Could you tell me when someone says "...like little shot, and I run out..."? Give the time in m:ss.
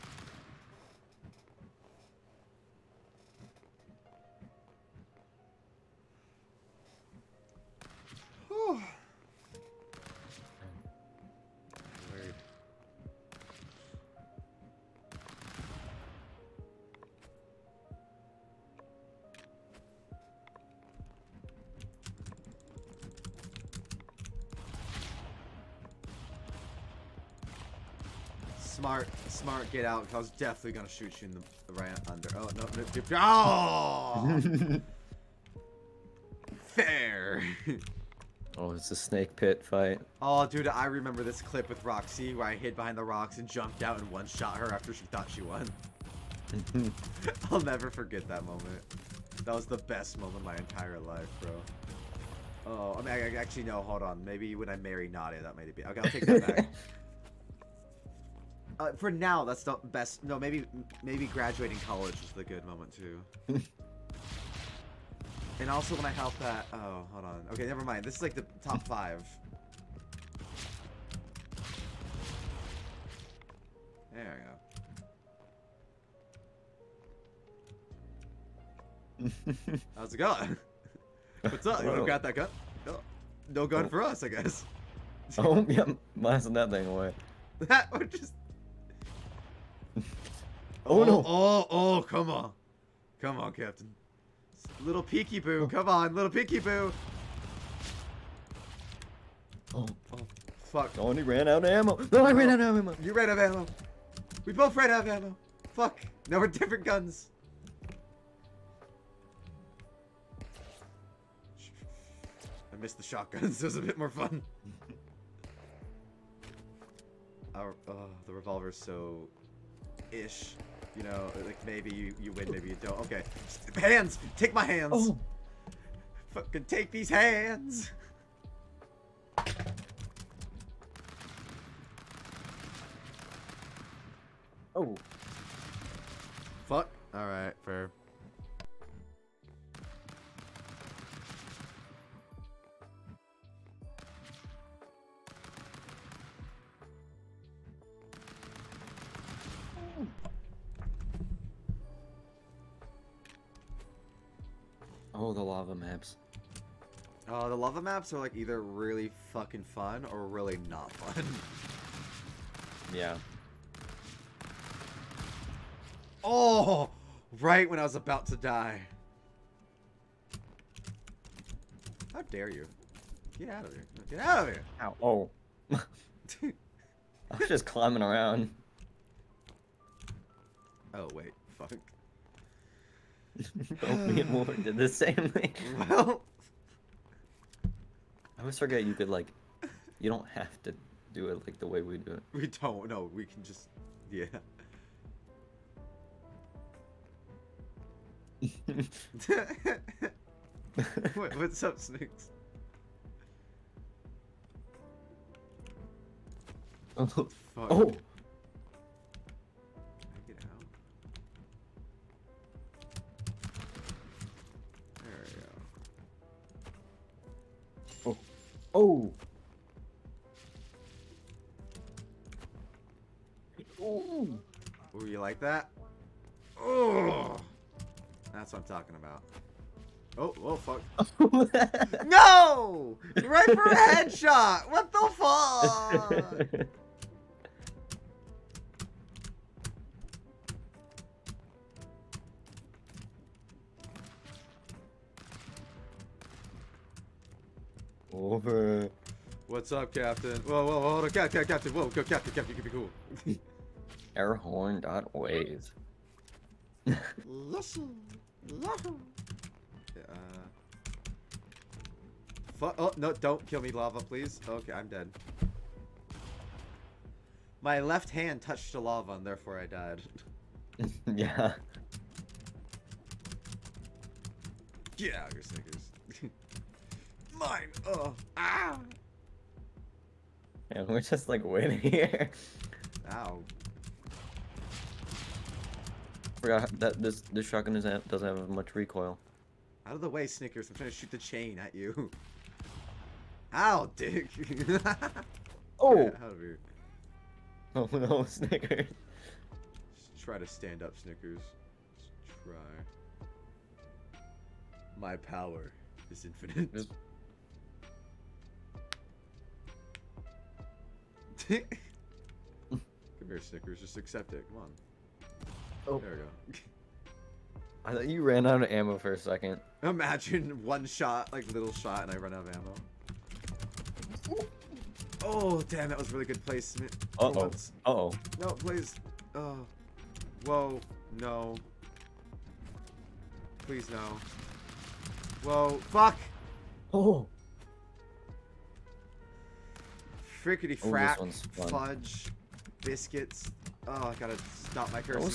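5:21.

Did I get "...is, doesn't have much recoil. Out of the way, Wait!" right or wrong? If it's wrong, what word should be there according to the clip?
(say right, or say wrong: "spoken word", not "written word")
wrong: "Snickers", not "Wait".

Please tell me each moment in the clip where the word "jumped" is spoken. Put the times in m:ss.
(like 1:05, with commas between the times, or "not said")
0:43.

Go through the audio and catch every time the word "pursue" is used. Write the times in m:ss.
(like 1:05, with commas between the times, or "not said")
not said.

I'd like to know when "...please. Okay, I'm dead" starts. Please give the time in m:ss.
4:24.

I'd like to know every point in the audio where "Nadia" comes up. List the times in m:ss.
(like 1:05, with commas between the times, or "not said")
0:55.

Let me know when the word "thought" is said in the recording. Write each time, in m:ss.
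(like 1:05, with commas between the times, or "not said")
0:45, 5:17.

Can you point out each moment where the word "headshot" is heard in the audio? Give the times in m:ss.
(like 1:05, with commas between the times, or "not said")
3:53.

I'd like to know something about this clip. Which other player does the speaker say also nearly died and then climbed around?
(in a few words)
Warren.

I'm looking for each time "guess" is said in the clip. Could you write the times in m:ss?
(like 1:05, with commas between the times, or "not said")
1:24.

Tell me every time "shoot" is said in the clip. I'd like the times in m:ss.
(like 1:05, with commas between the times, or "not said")
0:30, 4:50.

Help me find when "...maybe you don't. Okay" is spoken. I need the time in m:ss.
2:02.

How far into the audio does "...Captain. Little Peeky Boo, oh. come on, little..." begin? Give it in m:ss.
1:33.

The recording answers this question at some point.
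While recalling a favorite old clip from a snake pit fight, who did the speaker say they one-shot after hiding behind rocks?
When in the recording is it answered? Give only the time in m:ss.
0:41.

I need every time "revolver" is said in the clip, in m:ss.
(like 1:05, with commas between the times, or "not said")
1:58.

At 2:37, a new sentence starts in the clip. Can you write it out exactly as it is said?
Uh, the lava maps are like either really fucking fun or really not fun.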